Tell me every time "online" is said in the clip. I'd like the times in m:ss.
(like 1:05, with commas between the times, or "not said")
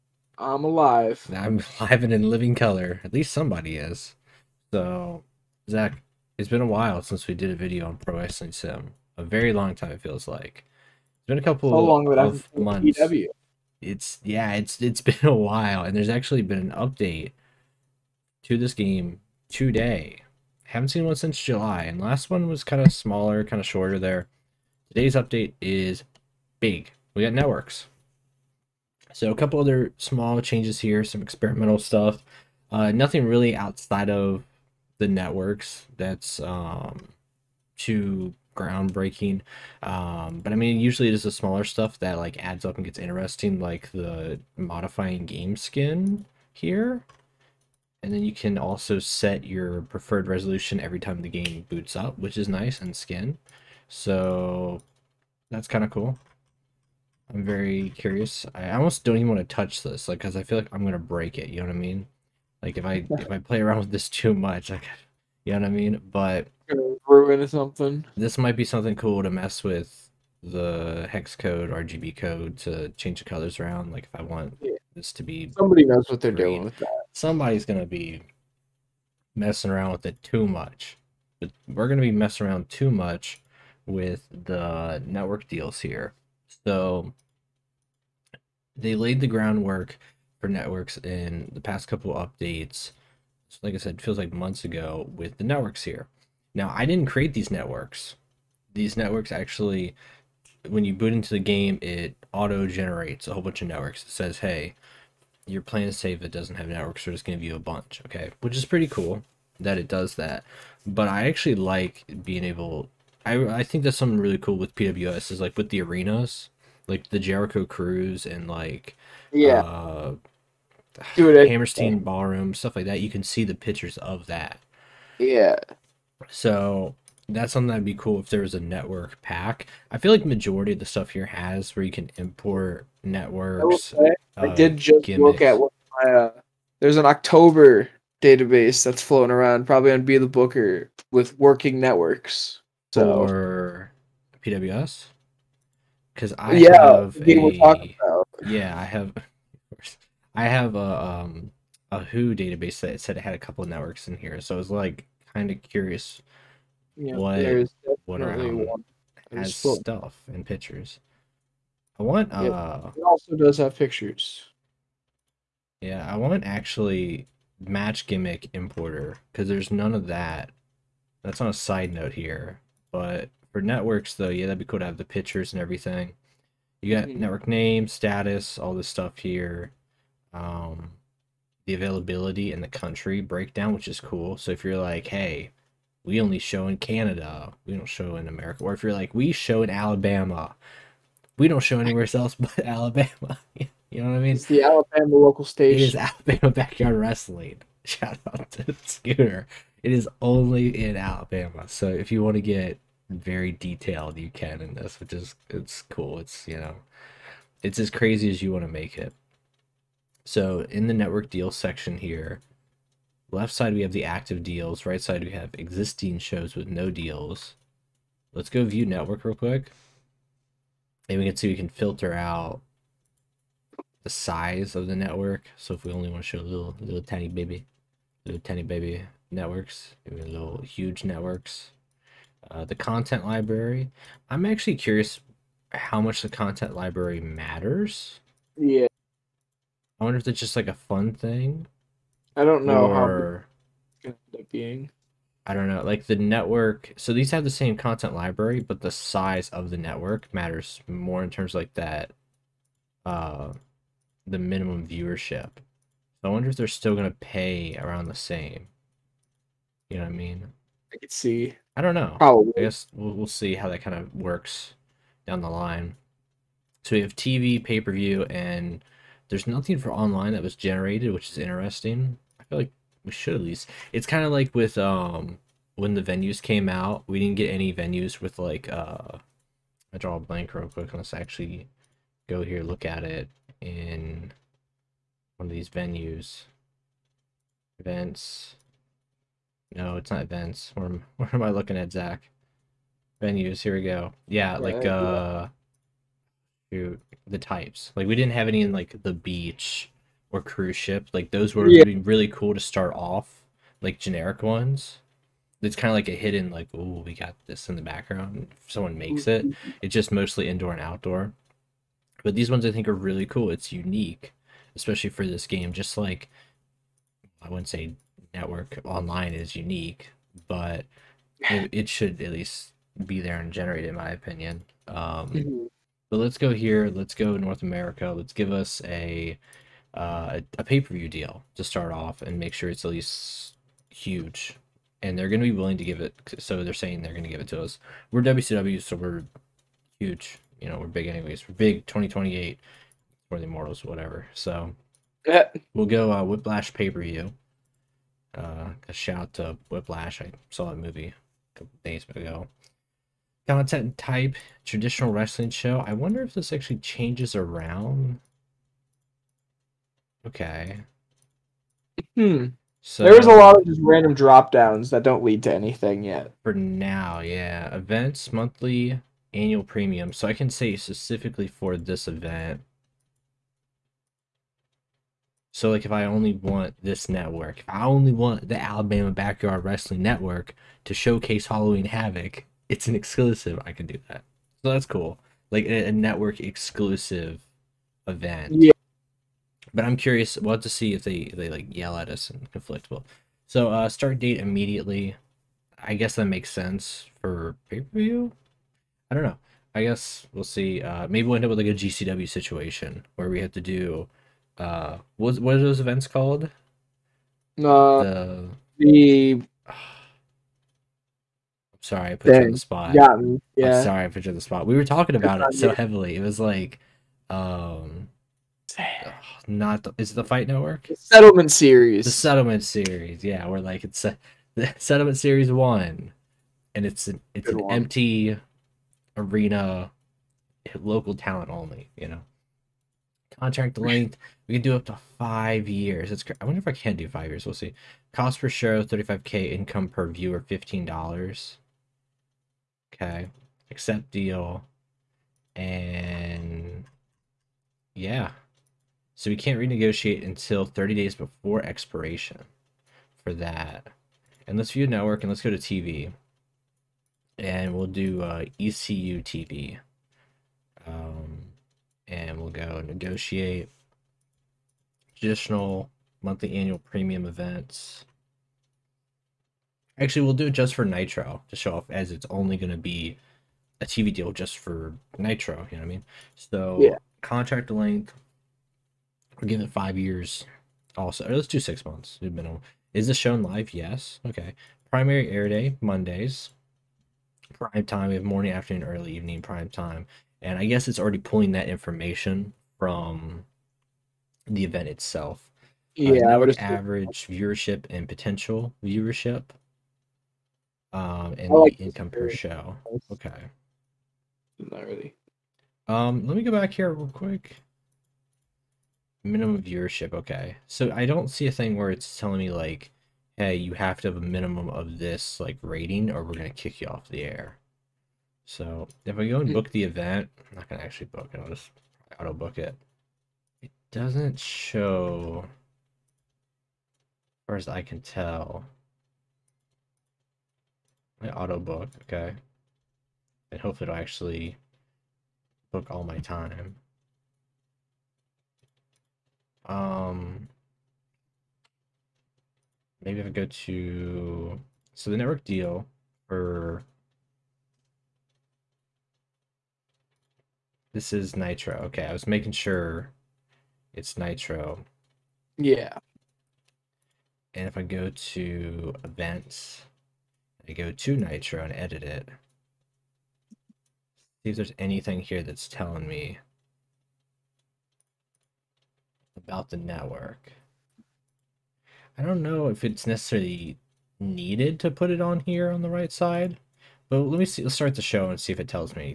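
4:29, 5:18.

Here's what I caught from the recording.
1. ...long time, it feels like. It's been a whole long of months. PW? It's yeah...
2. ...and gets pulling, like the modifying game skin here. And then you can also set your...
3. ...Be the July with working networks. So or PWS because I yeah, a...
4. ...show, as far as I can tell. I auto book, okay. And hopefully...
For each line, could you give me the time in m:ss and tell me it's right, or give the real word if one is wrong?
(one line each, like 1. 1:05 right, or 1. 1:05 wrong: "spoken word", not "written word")
1. 0:09 wrong: "couple", not "whole"
2. 0:42 wrong: "interesting", not "pulling"
3. 2:20 wrong: "Booker", not "July"
4. 8:44 right.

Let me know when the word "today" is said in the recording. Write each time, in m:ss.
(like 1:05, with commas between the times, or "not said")
0:19, 0:24.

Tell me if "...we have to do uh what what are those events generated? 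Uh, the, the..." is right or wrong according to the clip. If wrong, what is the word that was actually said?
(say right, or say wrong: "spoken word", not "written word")
wrong: "called", not "generated".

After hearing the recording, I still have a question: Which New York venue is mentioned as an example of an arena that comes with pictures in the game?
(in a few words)
Hammerstein Ballroom.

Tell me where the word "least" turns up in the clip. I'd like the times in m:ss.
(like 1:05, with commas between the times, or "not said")
0:03, 4:33, 5:22, 5:32.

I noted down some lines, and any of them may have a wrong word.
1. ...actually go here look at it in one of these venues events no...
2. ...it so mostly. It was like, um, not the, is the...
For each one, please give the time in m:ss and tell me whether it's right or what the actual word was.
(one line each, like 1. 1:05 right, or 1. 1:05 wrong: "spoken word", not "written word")
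1. 4:41 right
2. 6:55 wrong: "heavily", not "mostly".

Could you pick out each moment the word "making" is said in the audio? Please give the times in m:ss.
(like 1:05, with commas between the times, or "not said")
9:12.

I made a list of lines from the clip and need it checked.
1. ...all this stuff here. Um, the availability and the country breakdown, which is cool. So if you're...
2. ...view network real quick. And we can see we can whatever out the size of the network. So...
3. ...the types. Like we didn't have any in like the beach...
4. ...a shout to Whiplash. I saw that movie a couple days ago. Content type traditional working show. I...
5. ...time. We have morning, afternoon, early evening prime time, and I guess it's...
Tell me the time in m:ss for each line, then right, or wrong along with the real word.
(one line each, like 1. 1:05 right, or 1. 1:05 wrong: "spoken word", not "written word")
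1. 2:58 right
2. 3:38 wrong: "filter", not "whatever"
3. 4:56 right
4. 5:48 wrong: "wrestling", not "working"
5. 8:07 right.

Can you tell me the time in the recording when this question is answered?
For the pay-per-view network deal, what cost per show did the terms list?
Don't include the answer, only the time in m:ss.
7:18.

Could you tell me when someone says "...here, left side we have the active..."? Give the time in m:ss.
3:31.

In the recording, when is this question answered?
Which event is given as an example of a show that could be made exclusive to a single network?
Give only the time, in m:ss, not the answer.
6:21.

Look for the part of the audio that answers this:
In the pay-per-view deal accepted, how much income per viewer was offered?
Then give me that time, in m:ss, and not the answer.
7:20.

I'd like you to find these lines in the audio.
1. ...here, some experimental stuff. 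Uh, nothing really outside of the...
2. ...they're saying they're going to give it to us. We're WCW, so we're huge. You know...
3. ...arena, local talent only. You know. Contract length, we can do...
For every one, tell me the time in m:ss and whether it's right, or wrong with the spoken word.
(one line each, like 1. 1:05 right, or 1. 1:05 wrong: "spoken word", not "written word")
1. 0:30 right
2. 5:36 right
3. 7:09 right.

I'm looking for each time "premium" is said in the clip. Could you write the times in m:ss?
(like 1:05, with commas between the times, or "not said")
6:09, 7:46.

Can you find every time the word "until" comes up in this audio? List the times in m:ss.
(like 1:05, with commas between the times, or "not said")
7:30.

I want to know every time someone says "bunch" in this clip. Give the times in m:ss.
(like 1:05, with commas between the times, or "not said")
1:43, 1:47.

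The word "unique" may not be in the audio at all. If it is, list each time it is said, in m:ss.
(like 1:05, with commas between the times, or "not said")
5:13, 5:19.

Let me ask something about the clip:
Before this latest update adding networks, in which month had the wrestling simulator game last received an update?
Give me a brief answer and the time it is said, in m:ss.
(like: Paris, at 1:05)
July, at 0:21.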